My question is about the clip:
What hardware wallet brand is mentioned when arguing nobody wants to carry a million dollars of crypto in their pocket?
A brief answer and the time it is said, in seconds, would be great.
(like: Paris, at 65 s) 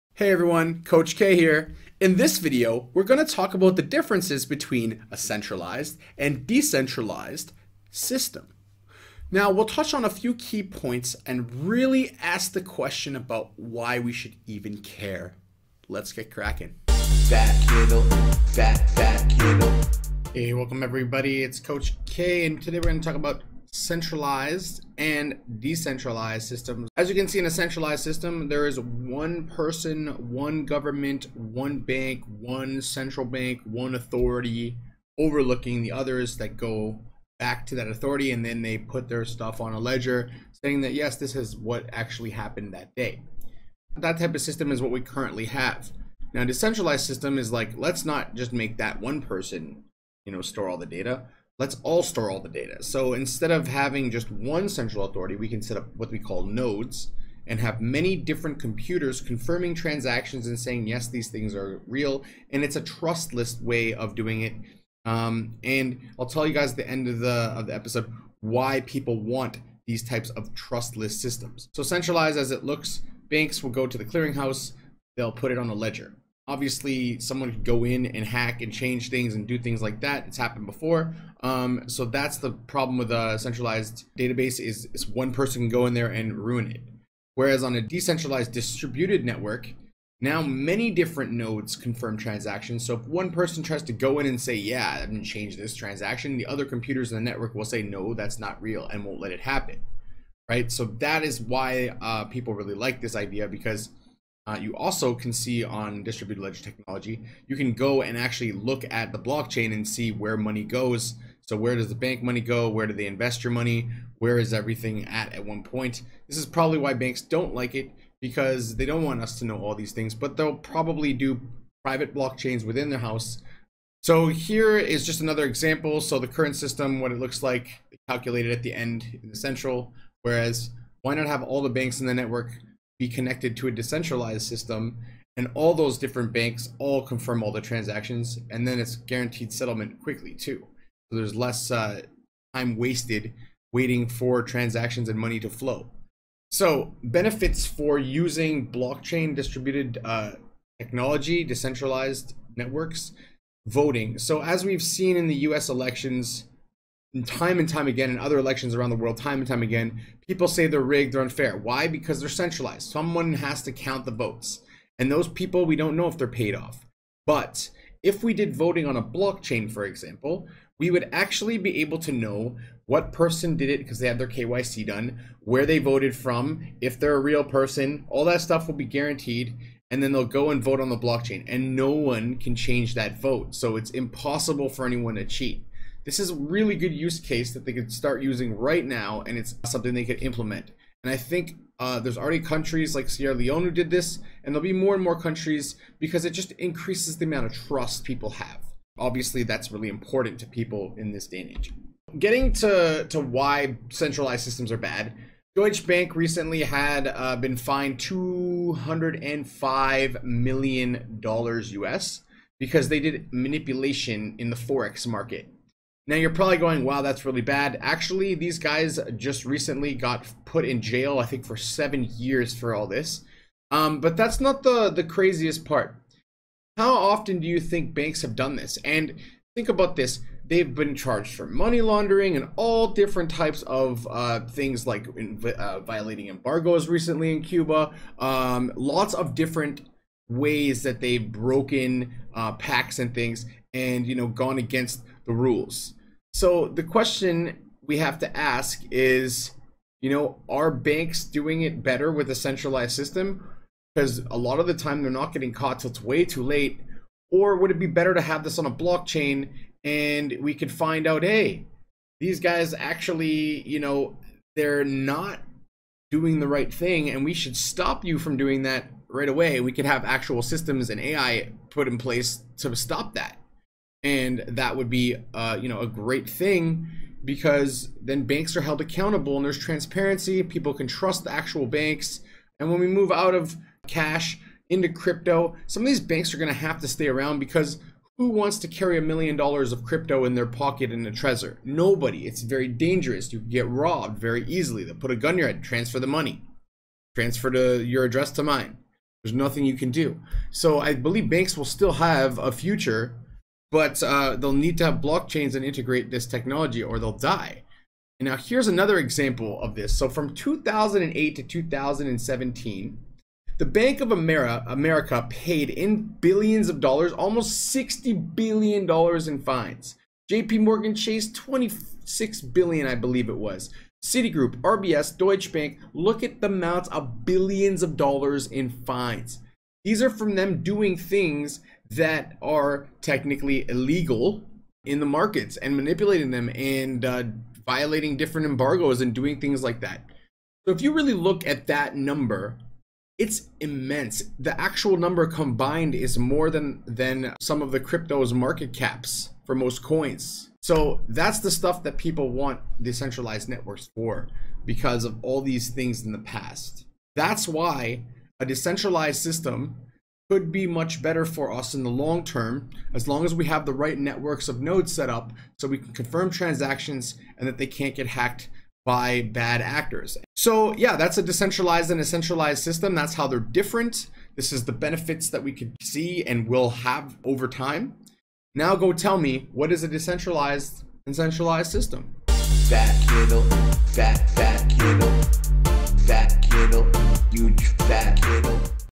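Trezor, at 291 s.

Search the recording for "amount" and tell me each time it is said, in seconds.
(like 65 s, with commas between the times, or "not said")
197 s, 326 s.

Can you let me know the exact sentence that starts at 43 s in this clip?
That type of system is what we currently have.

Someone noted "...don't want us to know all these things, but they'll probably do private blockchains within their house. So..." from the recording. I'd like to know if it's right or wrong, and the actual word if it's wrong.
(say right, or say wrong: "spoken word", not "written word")
right.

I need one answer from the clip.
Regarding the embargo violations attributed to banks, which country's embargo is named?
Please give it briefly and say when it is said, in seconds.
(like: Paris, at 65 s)
Cuba, at 237 s.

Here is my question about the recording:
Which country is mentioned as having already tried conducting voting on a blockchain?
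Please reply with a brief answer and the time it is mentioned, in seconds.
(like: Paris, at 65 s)
Sierra Leone, at 193 s.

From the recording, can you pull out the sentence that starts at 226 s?
How often do you think banks have done this?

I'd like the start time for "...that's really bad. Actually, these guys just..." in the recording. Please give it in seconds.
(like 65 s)
217 s.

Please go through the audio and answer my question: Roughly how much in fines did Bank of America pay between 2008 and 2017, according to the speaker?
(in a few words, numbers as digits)
$60 billion.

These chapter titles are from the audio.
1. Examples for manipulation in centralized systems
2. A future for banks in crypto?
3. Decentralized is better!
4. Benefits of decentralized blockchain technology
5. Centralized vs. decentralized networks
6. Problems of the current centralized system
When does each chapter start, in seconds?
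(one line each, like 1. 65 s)
1. 202 s
2. 282 s
3. 357 s
4. 146 s
5. 22 s
6. 71 s.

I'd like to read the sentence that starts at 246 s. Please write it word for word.
So the question we have to ask is, you know, are banks doing it better with a centralized system?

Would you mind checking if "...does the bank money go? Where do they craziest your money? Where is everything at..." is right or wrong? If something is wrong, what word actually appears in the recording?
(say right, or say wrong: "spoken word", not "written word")
wrong: "invest", not "craziest".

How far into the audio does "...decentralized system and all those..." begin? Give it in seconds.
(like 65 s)
133 s.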